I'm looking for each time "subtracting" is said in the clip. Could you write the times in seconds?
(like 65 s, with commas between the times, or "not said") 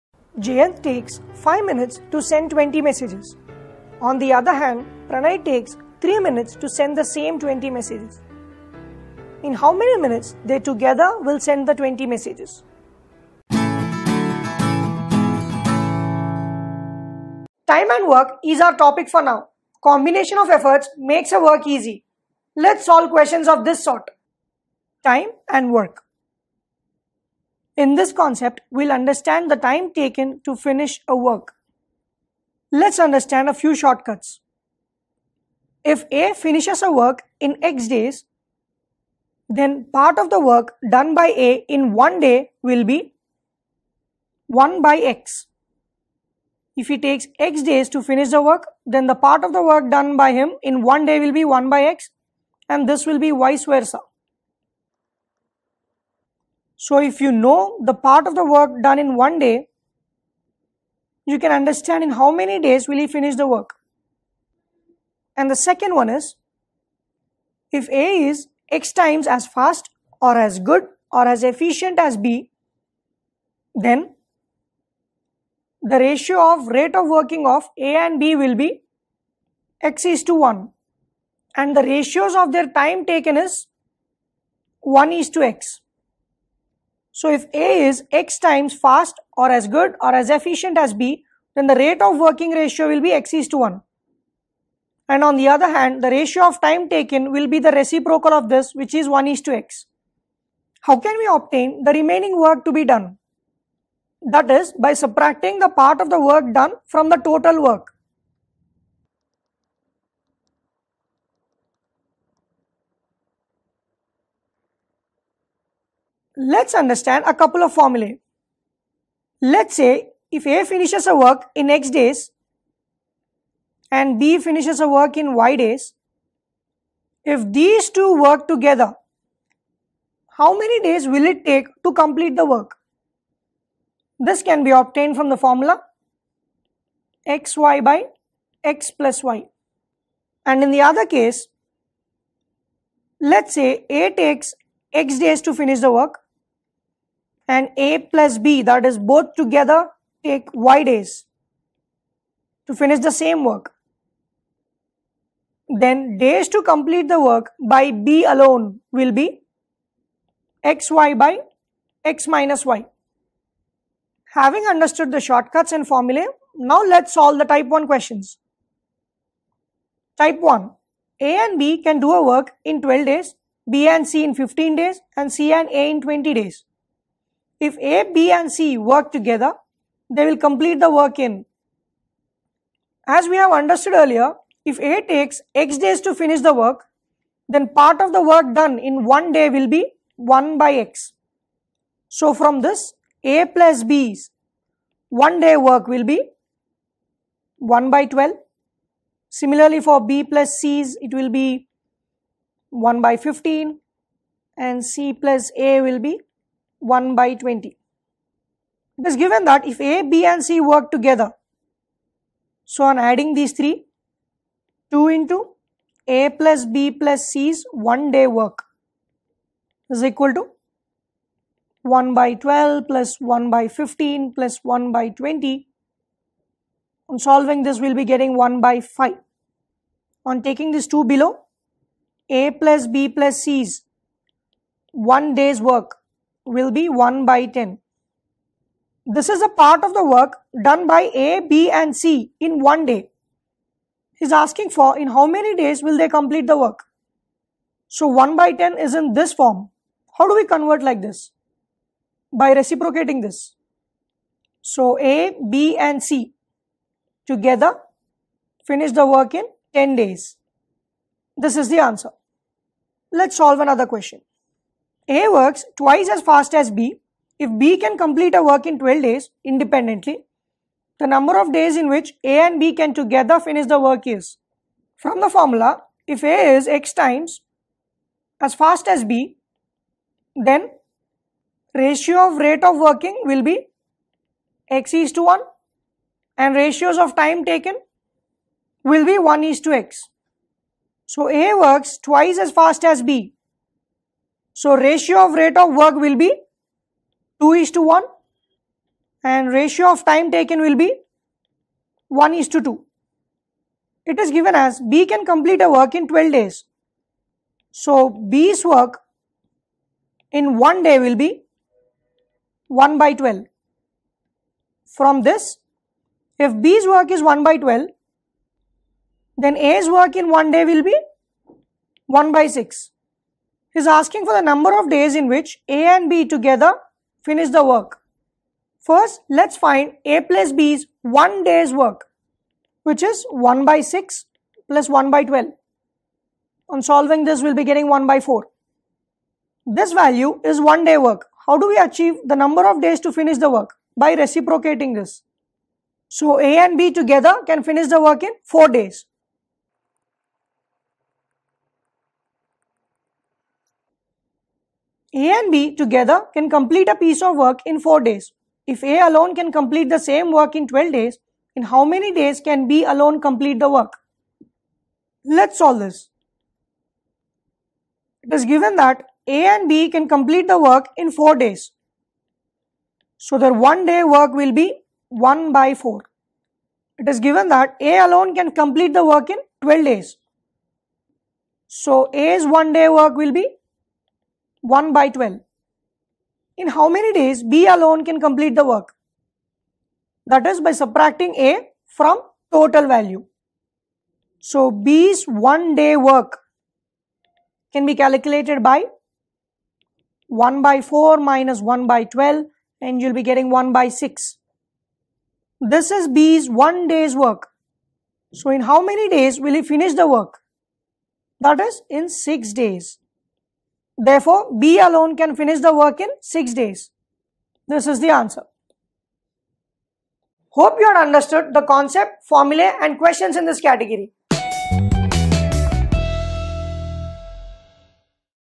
104 s, 390 s.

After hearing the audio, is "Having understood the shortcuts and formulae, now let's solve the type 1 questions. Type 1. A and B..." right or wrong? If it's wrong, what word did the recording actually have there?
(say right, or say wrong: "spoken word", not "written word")
right.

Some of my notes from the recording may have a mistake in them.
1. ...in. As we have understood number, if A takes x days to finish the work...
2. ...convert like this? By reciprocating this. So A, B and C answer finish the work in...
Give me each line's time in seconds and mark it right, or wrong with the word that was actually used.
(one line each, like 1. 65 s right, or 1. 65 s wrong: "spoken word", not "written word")
1. 181 s wrong: "earlier", not "number"
2. 250 s wrong: "together", not "answer".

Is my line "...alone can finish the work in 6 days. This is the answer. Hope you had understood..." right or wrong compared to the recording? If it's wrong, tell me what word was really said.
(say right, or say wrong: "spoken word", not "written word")
right.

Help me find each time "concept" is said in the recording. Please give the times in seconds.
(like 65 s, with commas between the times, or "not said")
28 s, 421 s.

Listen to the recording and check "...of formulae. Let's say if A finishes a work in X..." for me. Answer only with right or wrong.
right.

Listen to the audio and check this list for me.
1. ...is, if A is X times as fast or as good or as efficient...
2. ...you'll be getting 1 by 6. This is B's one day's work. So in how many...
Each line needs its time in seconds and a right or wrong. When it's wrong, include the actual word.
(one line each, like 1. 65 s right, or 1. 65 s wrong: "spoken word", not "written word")
1. 66 s right
2. 403 s right.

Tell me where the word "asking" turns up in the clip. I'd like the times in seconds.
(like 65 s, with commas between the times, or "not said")
244 s, 323 s.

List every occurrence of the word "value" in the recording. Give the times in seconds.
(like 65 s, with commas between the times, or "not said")
339 s, 392 s.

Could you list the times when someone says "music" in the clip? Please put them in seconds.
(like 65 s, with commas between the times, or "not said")
not said.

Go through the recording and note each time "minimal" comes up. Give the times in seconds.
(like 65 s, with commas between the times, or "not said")
not said.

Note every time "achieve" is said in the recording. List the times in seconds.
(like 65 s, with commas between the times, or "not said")
341 s.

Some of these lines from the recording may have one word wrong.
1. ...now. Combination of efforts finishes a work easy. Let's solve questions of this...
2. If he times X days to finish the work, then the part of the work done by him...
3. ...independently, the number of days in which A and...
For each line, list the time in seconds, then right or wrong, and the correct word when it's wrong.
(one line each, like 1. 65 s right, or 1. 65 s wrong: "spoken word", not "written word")
1. 19 s wrong: "makes", not "finishes"
2. 46 s wrong: "takes", not "times"
3. 269 s right.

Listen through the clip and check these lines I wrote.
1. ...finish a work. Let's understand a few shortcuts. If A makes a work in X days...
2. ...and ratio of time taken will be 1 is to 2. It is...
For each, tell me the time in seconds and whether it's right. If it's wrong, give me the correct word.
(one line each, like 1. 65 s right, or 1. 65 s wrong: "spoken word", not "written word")
1. 30 s wrong: "finishes", not "makes"
2. 299 s right.